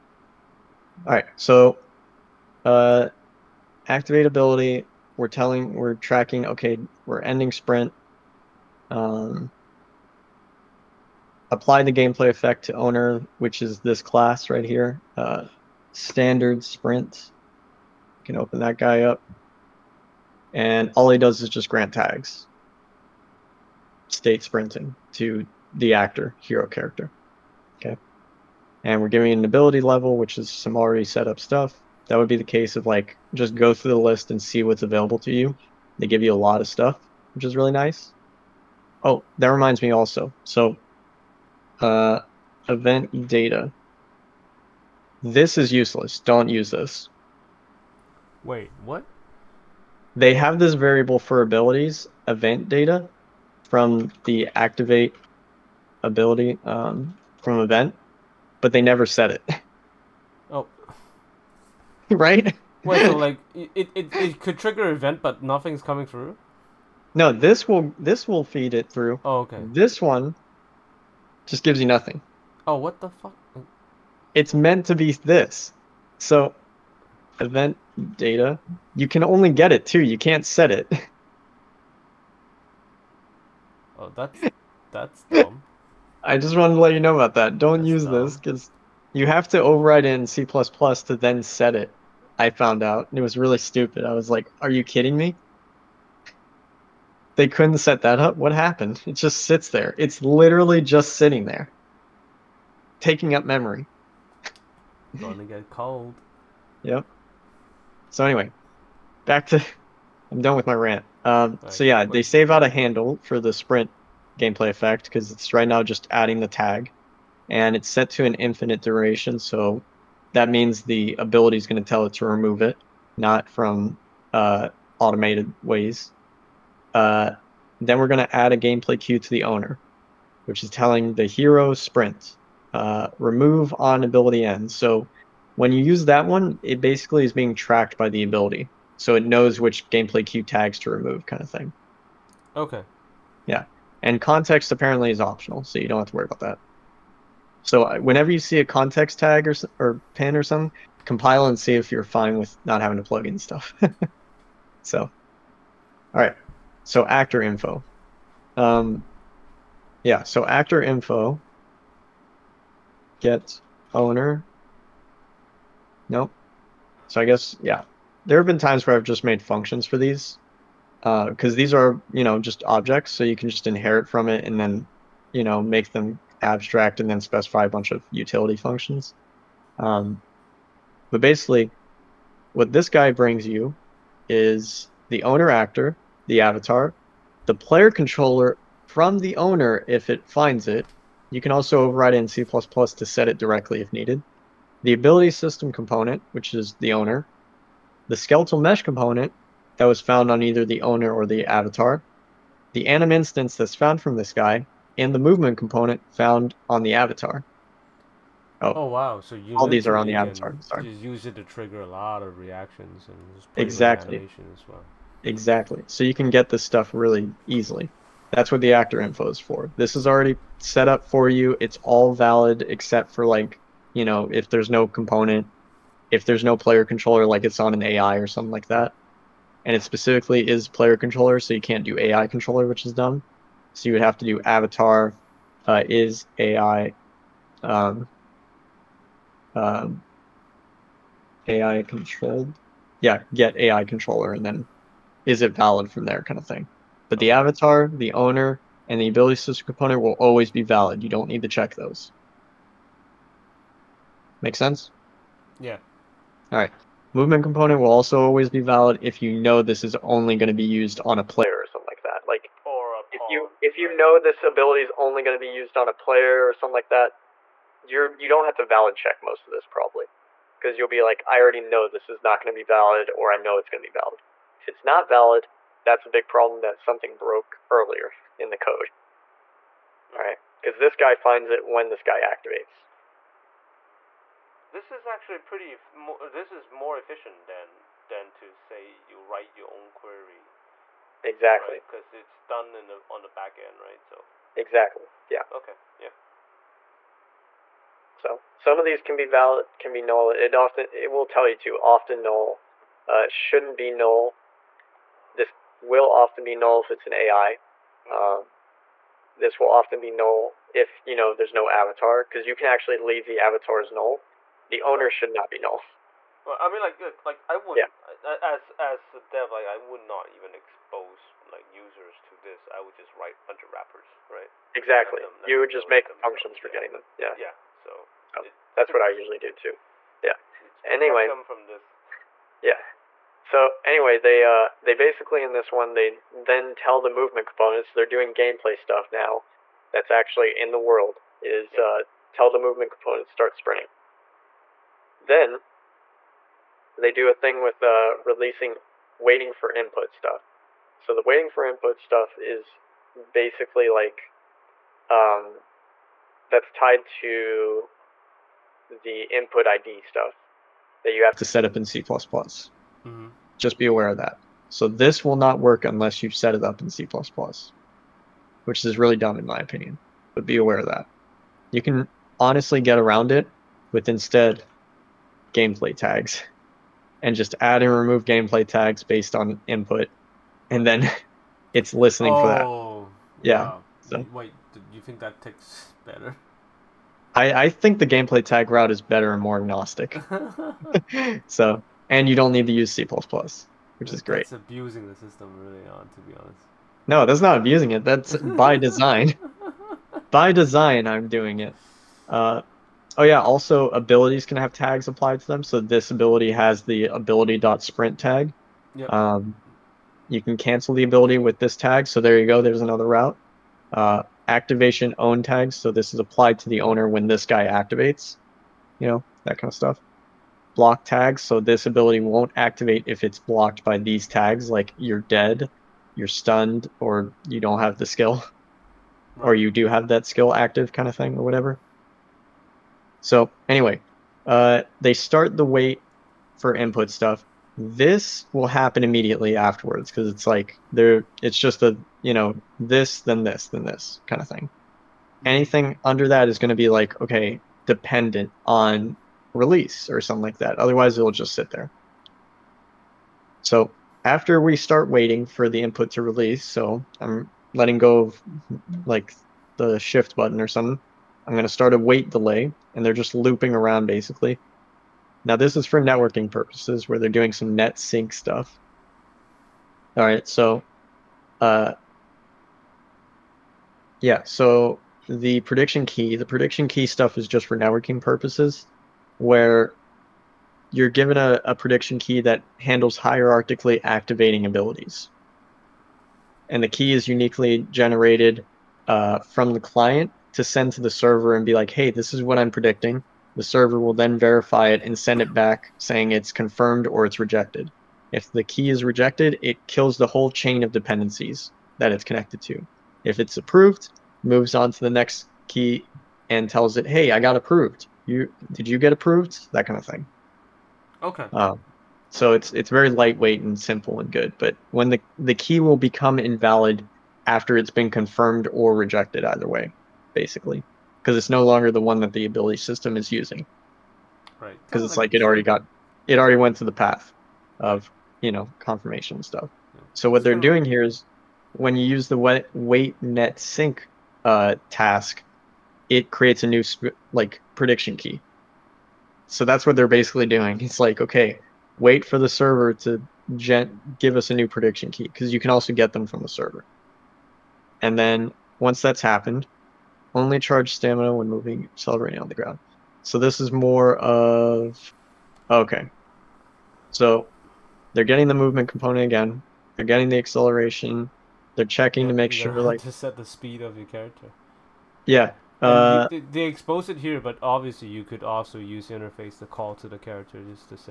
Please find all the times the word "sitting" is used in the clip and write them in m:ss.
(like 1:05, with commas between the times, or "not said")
1:41.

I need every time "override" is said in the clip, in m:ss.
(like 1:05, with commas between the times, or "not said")
1:29, 3:11.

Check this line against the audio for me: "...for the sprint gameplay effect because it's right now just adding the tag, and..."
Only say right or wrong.
right.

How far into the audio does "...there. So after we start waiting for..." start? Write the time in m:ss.
7:31.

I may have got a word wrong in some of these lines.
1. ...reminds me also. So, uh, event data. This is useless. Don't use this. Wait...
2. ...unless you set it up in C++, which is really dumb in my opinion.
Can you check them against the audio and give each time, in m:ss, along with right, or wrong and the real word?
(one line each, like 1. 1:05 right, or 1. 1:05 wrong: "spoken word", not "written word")
1. 0:39 right
2. 6:05 right.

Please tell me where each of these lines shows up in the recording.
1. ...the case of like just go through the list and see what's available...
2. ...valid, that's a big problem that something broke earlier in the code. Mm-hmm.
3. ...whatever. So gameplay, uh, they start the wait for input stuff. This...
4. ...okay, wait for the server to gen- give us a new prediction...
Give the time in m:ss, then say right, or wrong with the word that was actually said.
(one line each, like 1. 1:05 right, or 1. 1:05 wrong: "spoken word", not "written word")
1. 0:32 right
2. 4:35 right
3. 7:11 wrong: "anyway", not "gameplay"
4. 9:01 right.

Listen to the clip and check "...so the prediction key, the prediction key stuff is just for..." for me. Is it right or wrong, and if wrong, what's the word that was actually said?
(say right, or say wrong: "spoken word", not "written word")
right.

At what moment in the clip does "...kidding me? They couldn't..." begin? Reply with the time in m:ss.
1:34.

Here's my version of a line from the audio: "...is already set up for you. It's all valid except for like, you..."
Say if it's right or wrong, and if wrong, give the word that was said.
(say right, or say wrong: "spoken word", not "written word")
right.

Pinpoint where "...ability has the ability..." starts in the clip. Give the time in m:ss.
6:46.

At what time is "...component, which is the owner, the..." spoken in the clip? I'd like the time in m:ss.
3:15.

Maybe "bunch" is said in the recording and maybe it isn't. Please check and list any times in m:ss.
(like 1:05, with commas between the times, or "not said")
2:57, 5:23.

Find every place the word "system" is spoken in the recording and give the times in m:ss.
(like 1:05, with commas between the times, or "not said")
3:15, 4:09, 6:35, 8:42.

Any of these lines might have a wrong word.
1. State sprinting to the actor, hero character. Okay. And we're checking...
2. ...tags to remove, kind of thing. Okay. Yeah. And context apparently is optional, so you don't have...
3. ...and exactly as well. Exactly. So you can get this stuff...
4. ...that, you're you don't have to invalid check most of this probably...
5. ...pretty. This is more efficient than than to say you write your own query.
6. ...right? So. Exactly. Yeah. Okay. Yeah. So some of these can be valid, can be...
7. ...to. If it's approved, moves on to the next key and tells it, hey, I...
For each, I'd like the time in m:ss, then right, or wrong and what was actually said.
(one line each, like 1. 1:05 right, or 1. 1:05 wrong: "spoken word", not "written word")
1. 0:24 wrong: "giving", not "checking"
2. 2:20 right
3. 3:33 right
4. 4:26 wrong: "valid", not "invalid"
5. 4:45 right
6. 4:53 right
7. 8:22 right.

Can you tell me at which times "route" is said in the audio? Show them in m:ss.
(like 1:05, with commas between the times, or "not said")
6:28, 6:53.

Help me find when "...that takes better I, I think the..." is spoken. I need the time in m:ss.
6:25.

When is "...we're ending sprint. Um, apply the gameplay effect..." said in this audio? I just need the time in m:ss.
0:07.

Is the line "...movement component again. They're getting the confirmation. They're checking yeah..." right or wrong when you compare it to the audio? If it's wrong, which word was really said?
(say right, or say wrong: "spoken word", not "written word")
wrong: "acceleration", not "confirmation".